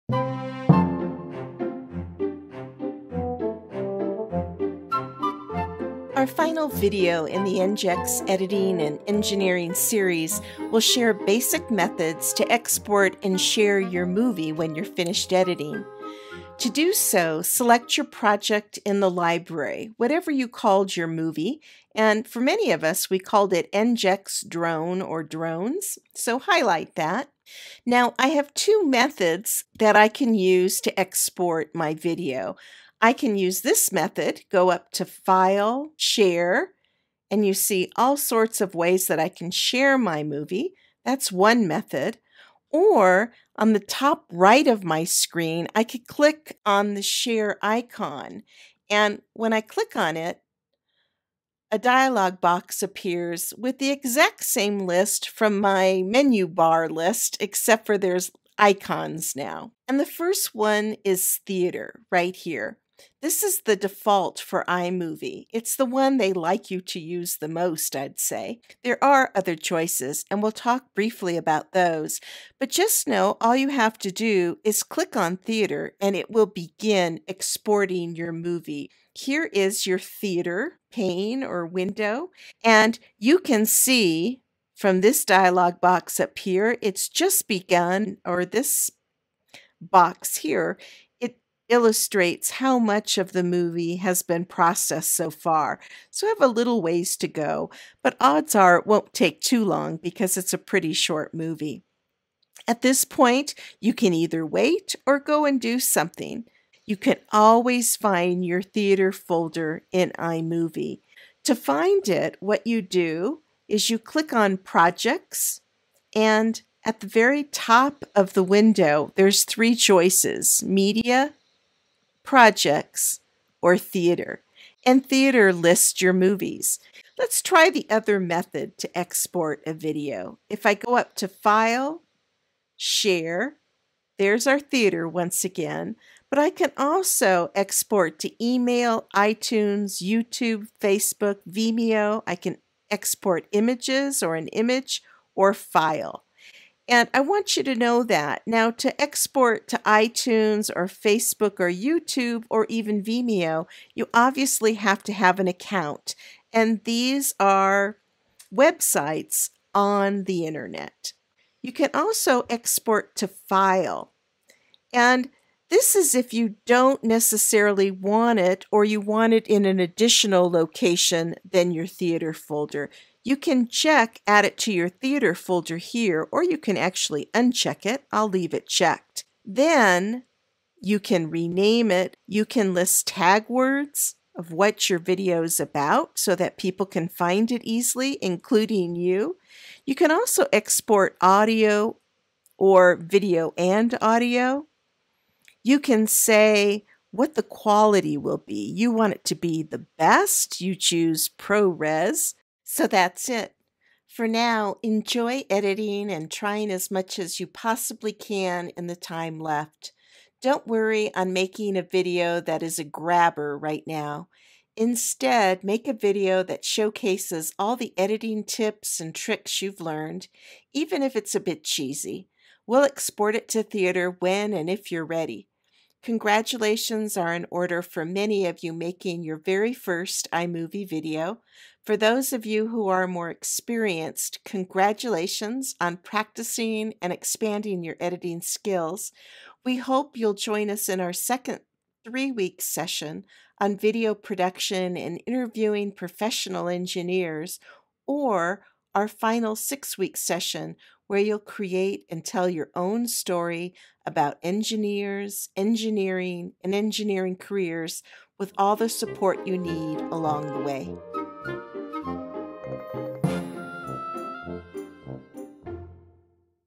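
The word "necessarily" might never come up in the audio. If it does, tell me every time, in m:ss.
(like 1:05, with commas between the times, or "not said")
2:47.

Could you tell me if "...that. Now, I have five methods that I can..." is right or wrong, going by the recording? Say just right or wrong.
wrong.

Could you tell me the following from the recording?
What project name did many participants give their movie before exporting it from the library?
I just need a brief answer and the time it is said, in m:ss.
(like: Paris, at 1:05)
EngEx drone, at 0:23.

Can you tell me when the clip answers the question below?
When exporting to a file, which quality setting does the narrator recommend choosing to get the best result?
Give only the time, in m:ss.
3:21.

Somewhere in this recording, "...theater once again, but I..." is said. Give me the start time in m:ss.
2:14.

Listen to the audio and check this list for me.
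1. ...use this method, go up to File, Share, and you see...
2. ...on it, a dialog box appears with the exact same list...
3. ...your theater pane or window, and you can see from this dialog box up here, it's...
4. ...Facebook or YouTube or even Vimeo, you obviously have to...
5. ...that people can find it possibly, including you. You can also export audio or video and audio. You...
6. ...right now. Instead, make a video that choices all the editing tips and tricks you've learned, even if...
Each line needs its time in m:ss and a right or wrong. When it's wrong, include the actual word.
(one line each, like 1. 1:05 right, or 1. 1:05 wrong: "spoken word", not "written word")
1. 0:33 right
2. 0:49 right
3. 1:19 right
4. 2:30 right
5. 3:06 wrong: "easily", not "possibly"
6. 3:33 wrong: "showcases", not "choices".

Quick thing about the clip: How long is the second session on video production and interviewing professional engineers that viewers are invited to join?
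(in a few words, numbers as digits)
3 weeks.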